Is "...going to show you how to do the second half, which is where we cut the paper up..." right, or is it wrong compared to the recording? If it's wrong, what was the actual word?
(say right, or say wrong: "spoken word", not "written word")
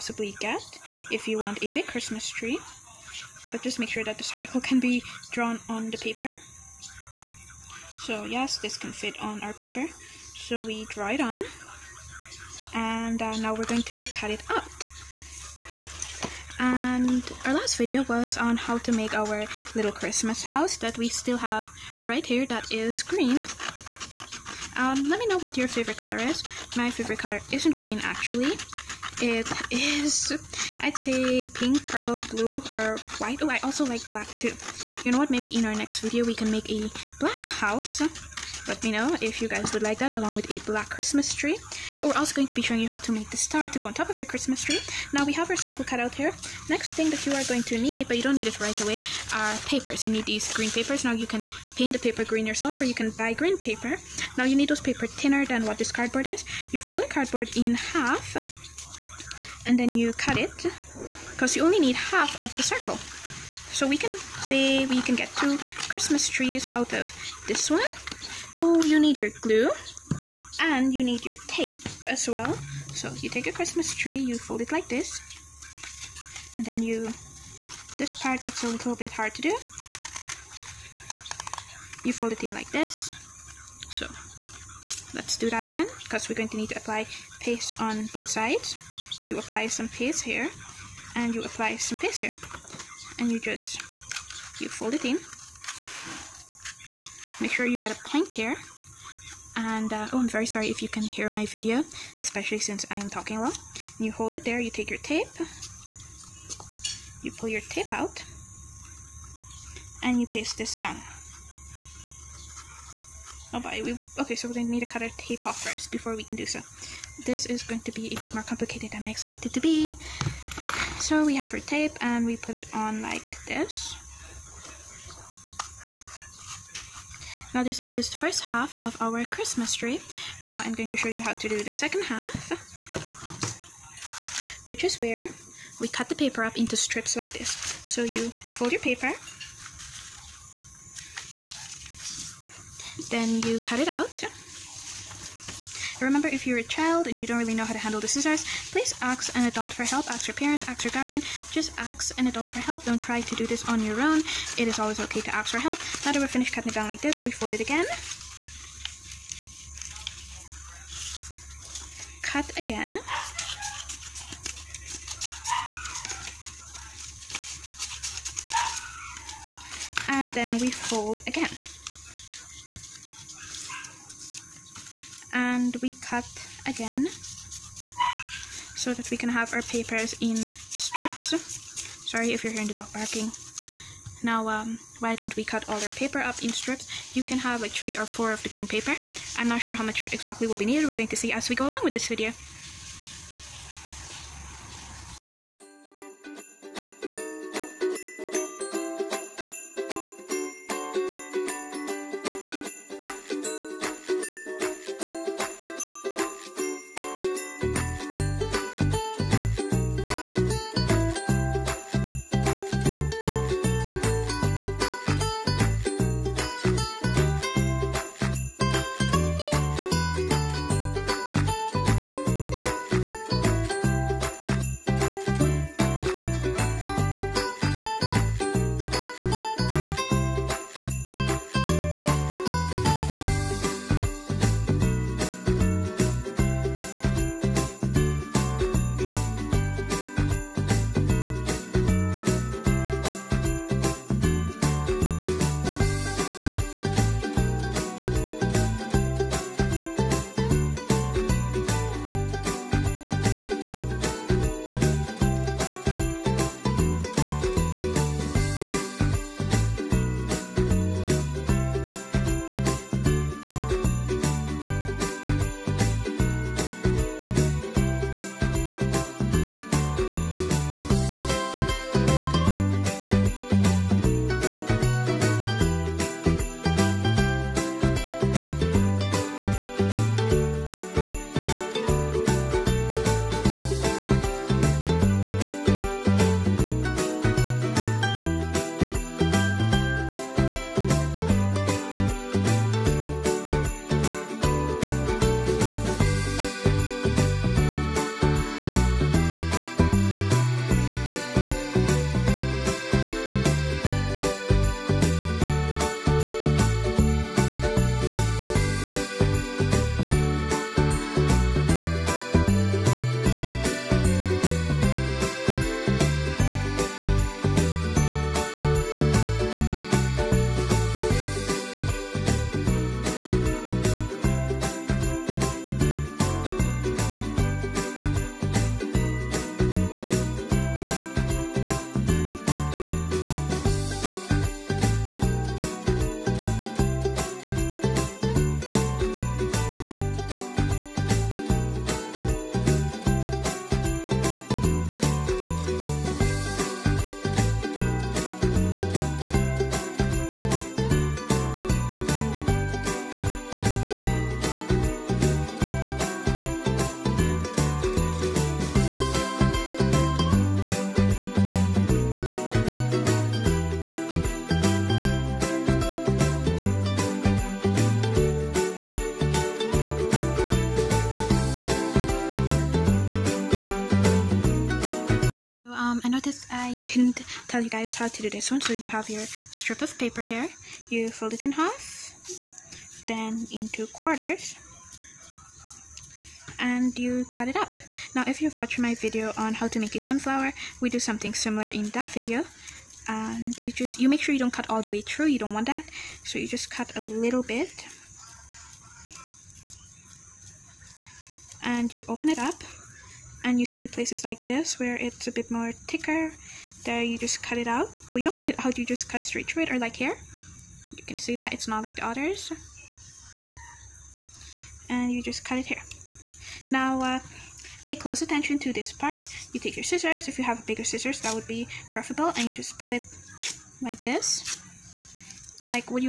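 right.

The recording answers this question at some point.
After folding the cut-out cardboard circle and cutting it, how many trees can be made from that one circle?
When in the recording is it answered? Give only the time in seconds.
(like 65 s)
65 s.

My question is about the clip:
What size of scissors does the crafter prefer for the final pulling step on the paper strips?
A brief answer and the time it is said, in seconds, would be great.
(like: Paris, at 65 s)
bigger scissors, at 420 s.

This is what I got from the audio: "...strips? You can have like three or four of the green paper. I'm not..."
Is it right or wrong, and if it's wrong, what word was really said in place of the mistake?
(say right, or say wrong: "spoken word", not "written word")
right.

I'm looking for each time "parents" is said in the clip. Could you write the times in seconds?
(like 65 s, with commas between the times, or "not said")
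150 s.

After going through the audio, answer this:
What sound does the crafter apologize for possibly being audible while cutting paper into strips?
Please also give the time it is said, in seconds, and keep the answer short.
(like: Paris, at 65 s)
the dog barking, at 182 s.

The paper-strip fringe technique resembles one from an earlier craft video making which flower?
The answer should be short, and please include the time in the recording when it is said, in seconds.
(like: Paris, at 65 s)
sunflower, at 389 s.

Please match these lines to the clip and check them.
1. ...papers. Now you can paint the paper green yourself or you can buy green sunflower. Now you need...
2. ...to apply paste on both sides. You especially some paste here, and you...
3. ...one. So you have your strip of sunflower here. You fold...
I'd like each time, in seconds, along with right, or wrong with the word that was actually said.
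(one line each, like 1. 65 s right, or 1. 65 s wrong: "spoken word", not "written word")
1. 50 s wrong: "paper", not "sunflower"
2. 86 s wrong: "apply", not "especially"
3. 378 s wrong: "paper", not "sunflower".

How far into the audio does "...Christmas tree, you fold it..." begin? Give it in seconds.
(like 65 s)
73 s.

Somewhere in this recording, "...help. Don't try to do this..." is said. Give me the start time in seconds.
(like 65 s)
152 s.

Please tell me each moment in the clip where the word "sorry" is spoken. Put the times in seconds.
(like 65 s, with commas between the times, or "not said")
100 s, 182 s.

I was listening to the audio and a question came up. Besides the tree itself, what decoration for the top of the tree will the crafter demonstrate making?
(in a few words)
the star.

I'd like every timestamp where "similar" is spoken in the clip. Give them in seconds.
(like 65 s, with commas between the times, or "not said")
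391 s.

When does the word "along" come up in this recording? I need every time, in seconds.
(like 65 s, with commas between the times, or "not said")
40 s, 191 s.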